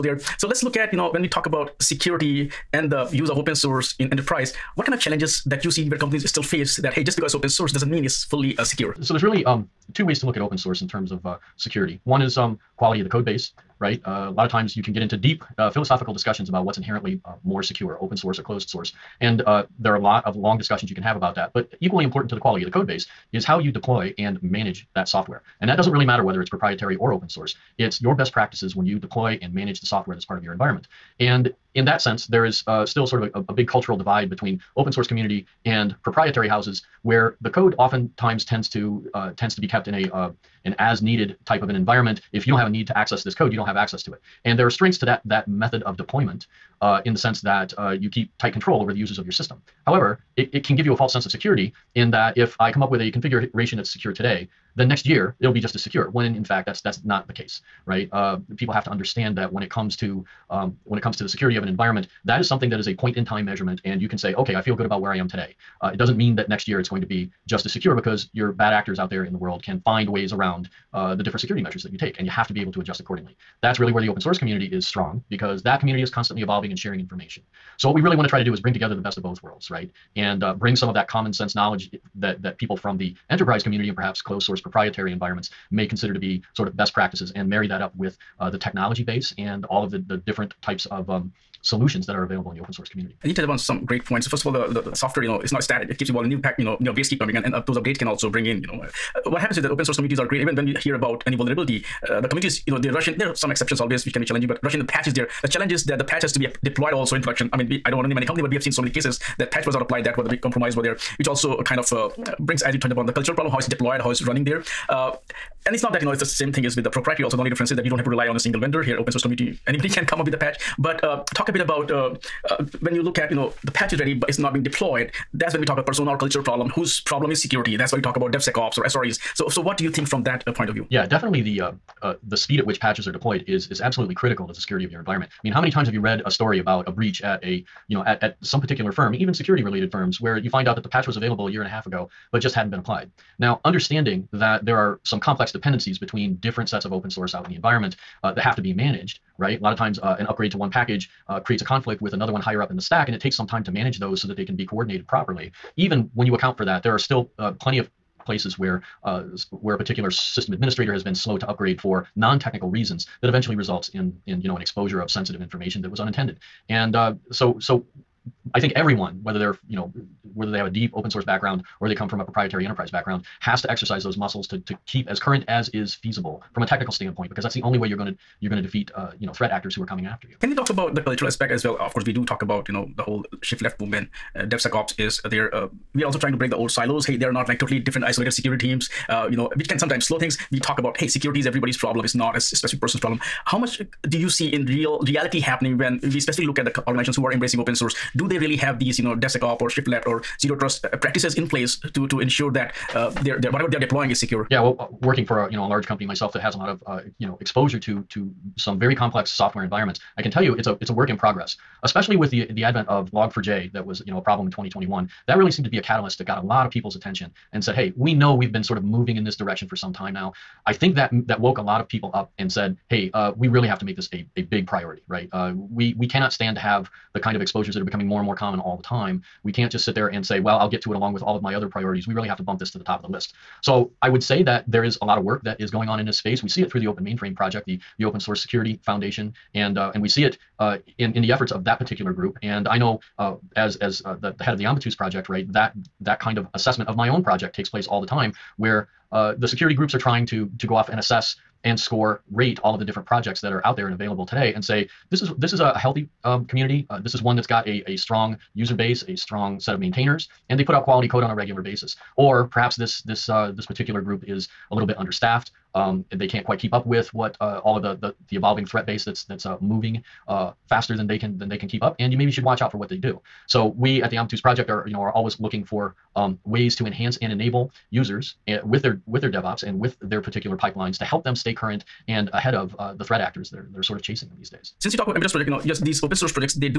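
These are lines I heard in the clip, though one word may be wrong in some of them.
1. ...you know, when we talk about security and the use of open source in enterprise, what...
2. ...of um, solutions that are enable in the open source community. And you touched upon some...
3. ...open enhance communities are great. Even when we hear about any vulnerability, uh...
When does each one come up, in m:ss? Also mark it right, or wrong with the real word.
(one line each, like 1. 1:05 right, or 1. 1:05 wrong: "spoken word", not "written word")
1. 0:00 right
2. 1:30 wrong: "available", not "enable"
3. 1:39 wrong: "source", not "enhance".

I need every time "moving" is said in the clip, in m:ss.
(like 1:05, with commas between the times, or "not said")
3:38, 4:29.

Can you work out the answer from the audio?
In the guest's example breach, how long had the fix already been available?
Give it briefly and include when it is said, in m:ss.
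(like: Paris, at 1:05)
a year and a half, at 2:21.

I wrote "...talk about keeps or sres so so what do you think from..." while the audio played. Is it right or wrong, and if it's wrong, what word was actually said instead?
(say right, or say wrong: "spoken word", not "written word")
wrong: "devsecops", not "keeps".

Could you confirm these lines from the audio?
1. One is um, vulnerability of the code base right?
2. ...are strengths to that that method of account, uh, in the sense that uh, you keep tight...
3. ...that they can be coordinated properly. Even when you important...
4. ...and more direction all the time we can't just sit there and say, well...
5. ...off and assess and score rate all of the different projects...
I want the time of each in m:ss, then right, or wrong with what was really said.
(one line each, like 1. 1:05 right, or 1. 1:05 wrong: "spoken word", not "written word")
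1. 0:12 wrong: "quality", not "vulnerability"
2. 0:44 wrong: "deployment", not "account"
3. 2:34 wrong: "account", not "important"
4. 3:48 wrong: "common", not "direction"
5. 4:10 right.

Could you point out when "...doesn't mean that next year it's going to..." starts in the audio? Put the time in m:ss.
1:05.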